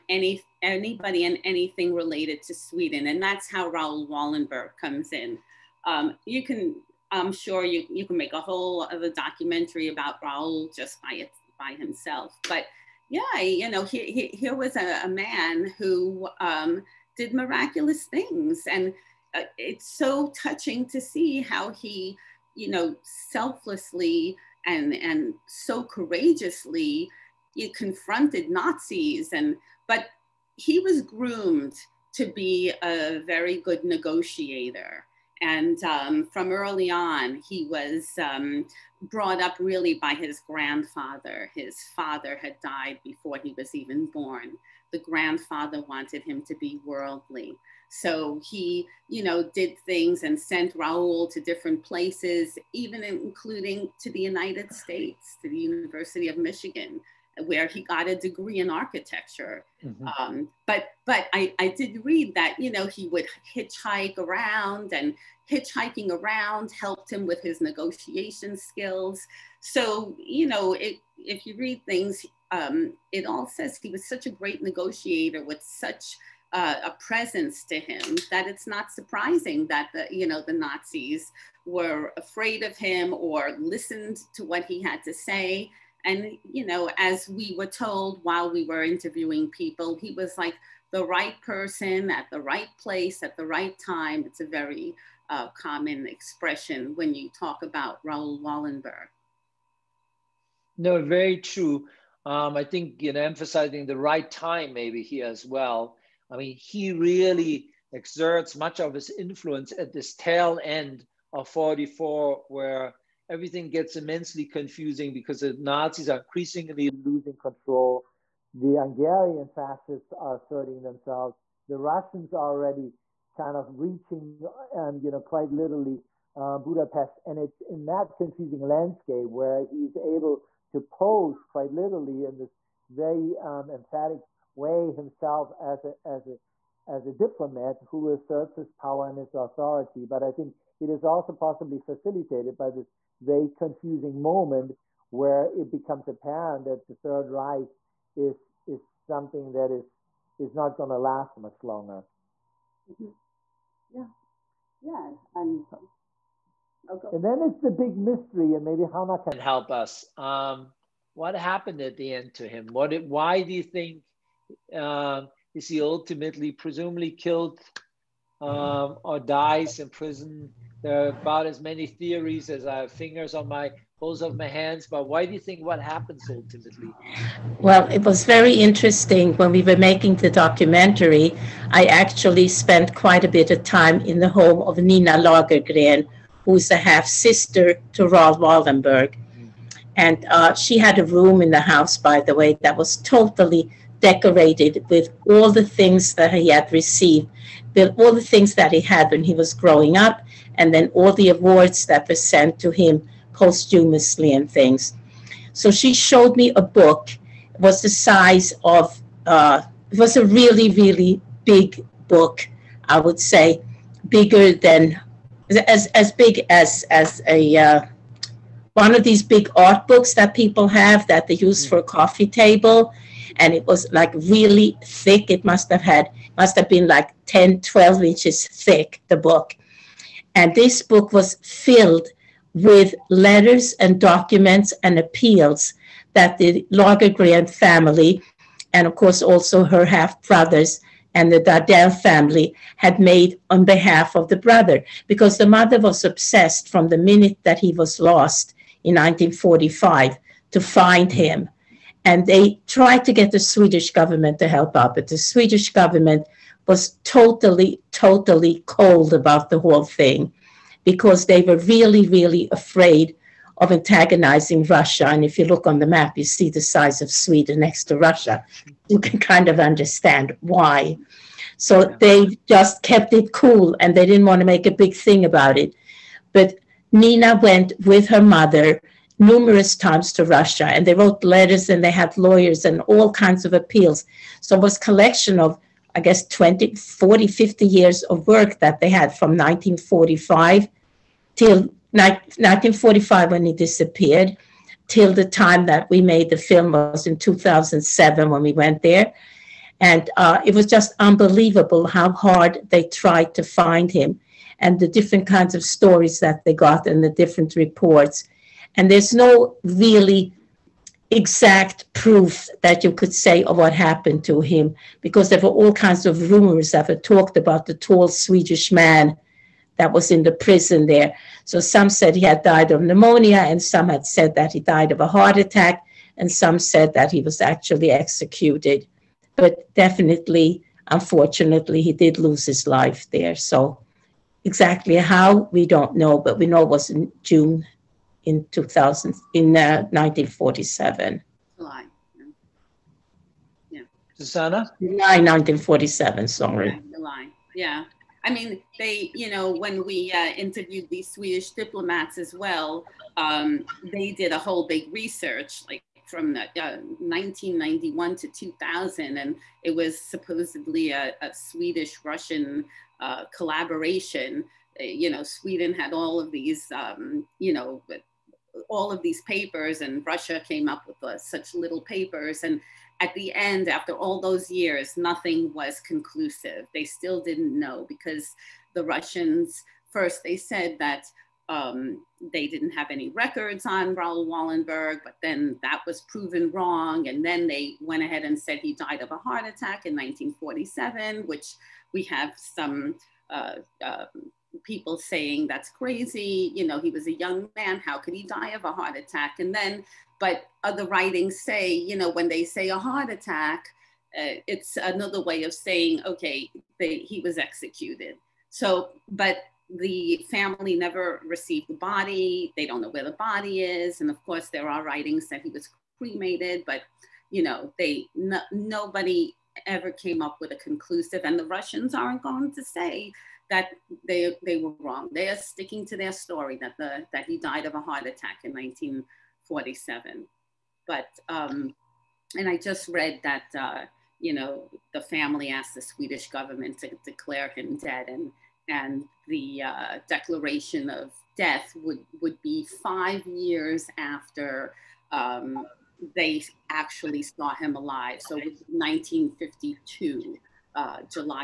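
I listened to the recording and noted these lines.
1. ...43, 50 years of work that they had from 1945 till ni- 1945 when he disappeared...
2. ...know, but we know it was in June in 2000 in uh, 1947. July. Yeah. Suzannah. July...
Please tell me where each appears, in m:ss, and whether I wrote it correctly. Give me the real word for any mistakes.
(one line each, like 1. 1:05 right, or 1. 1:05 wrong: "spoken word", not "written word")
1. 4:46 wrong: "40", not "43"
2. 5:35 right.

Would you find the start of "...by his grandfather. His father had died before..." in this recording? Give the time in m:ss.
0:39.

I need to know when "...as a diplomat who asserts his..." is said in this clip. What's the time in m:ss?
2:16.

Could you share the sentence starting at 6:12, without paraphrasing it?
And at the end, after all those years, nothing was conclusive.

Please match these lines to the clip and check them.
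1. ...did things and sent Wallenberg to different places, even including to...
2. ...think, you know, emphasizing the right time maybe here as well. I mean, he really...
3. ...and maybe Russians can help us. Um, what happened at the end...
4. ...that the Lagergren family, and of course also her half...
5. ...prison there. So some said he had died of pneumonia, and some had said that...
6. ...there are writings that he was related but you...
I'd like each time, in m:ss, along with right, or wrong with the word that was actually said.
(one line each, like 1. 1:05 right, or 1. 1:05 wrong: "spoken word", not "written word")
1. 0:49 wrong: "Raoul", not "Wallenberg"
2. 1:42 right
3. 2:38 wrong: "Chana", not "Russians"
4. 3:56 right
5. 5:20 right
6. 6:54 wrong: "cremated", not "related".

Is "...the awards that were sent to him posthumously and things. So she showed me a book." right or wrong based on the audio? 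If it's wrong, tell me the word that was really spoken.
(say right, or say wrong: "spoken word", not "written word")
right.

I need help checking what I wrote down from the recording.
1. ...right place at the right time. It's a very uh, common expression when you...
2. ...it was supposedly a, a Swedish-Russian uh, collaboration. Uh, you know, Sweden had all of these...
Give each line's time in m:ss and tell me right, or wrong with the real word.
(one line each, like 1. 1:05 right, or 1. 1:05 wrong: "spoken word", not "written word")
1. 1:32 right
2. 5:59 right.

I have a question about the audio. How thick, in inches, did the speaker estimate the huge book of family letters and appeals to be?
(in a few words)
10 to 12 inches.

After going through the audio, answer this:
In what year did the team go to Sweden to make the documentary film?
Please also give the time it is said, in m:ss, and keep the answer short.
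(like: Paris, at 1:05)
2007, at 4:57.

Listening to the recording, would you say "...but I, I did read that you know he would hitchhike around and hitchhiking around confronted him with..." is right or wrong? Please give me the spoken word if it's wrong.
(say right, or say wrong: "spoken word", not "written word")
wrong: "helped", not "confronted".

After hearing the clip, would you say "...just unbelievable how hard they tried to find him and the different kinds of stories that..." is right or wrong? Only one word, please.
right.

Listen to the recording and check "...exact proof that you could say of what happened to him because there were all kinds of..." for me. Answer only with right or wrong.
right.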